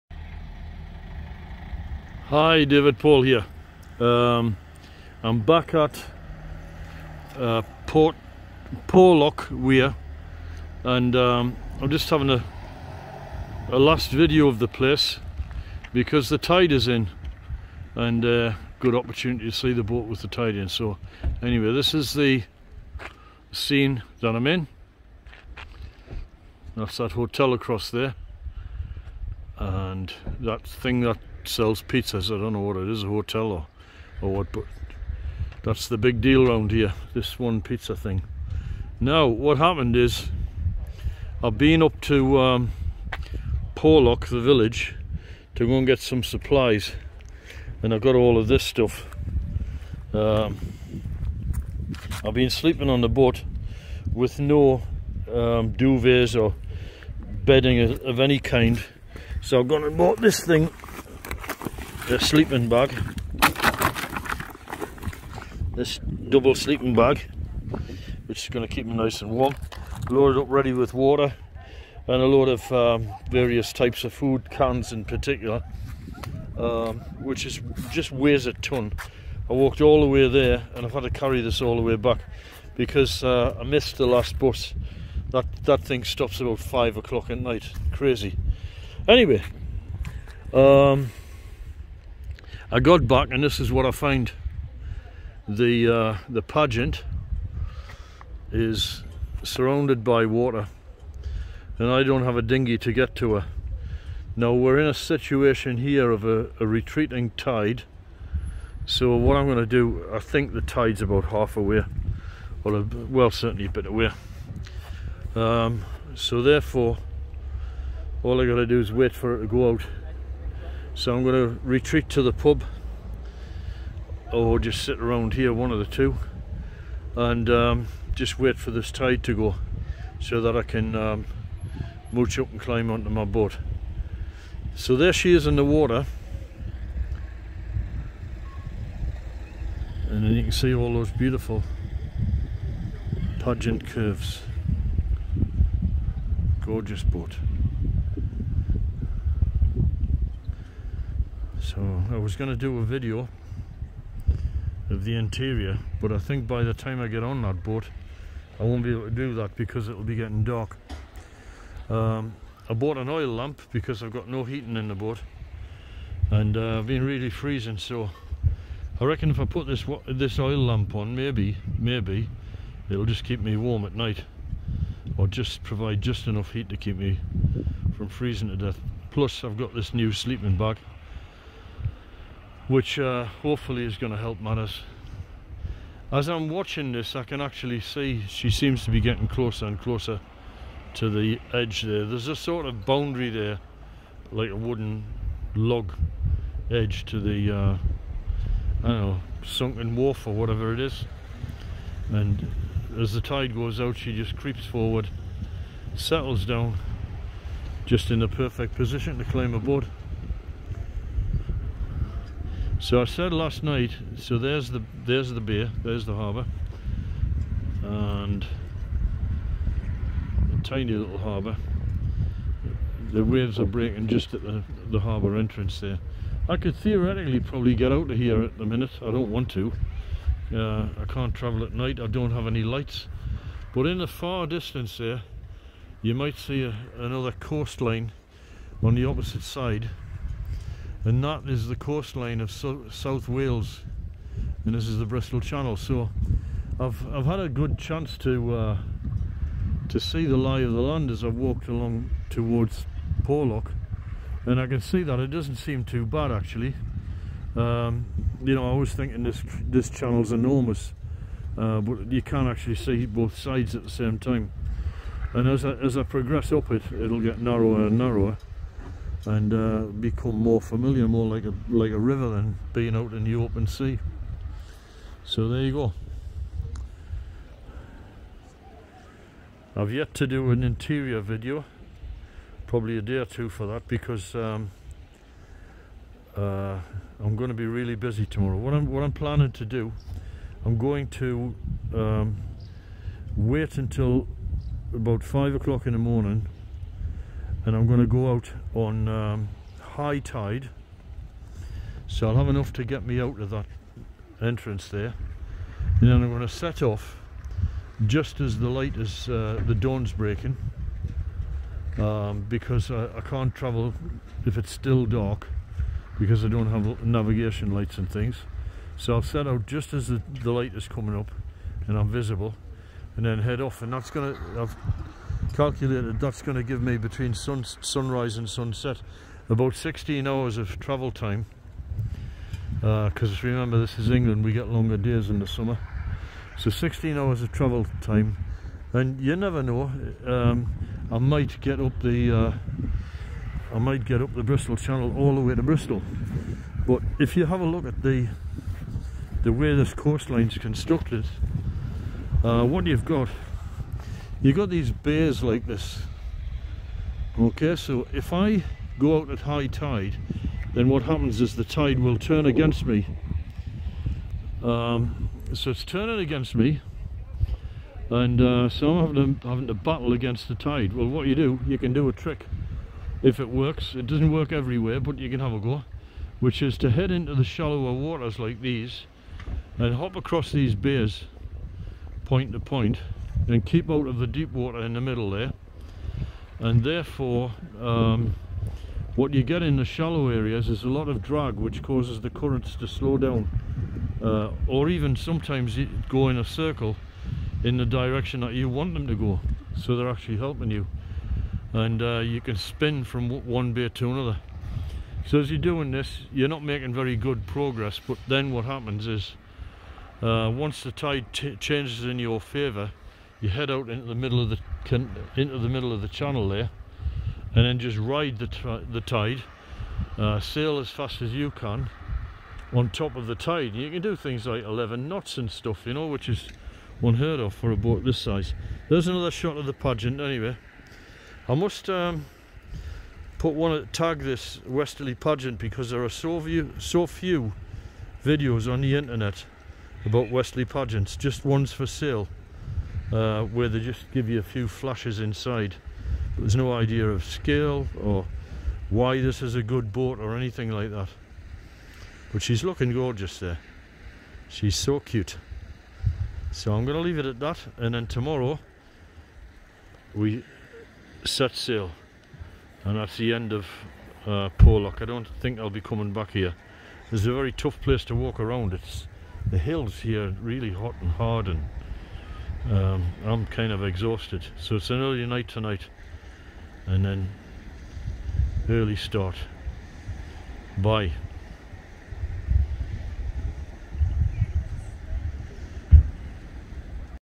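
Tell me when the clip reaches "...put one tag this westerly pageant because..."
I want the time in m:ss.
7:13.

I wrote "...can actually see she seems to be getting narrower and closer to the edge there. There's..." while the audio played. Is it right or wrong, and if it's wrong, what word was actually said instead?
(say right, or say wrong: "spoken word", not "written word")
wrong: "closer", not "narrower".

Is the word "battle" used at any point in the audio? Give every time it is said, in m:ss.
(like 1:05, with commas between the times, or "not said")
6:09.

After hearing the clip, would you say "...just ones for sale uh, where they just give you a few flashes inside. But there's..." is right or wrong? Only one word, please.
right.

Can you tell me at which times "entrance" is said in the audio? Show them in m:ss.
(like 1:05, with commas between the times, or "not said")
3:45, 5:04.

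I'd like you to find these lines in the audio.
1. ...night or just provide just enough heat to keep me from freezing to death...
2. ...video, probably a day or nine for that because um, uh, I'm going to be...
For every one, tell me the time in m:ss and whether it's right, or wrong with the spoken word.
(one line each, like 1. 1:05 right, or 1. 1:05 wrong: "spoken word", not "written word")
1. 2:53 right
2. 4:41 wrong: "two", not "nine".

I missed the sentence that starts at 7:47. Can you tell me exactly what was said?
It's a very tough place to walk around.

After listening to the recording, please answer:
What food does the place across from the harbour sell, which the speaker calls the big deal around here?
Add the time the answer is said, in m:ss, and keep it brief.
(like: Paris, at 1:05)
Pizza, at 0:31.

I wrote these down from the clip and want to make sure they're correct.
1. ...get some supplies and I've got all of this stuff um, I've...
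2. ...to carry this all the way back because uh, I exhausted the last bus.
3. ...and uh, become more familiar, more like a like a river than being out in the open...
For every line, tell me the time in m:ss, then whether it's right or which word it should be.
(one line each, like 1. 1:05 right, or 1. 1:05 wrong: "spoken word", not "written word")
1. 0:45 right
2. 1:21 wrong: "missed", not "exhausted"
3. 4:29 right.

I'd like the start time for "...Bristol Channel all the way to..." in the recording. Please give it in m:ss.
5:44.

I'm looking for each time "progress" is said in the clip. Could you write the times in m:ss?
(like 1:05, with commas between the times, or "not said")
4:26, 6:47.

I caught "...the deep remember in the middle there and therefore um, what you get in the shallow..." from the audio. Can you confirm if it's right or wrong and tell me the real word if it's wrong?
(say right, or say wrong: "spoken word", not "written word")
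wrong: "water", not "remember".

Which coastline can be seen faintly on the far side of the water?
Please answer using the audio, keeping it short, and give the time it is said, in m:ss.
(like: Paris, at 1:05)
South Wales, at 4:02.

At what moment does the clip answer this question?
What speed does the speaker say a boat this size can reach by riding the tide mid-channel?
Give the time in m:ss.
7:04.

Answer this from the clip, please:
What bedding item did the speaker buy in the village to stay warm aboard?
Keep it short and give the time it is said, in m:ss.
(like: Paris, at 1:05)
Double sleeping bag, at 1:05.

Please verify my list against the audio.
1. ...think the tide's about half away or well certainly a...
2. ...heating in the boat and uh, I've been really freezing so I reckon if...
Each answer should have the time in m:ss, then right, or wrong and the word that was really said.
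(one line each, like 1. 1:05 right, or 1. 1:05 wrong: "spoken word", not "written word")
1. 1:50 right
2. 2:44 right.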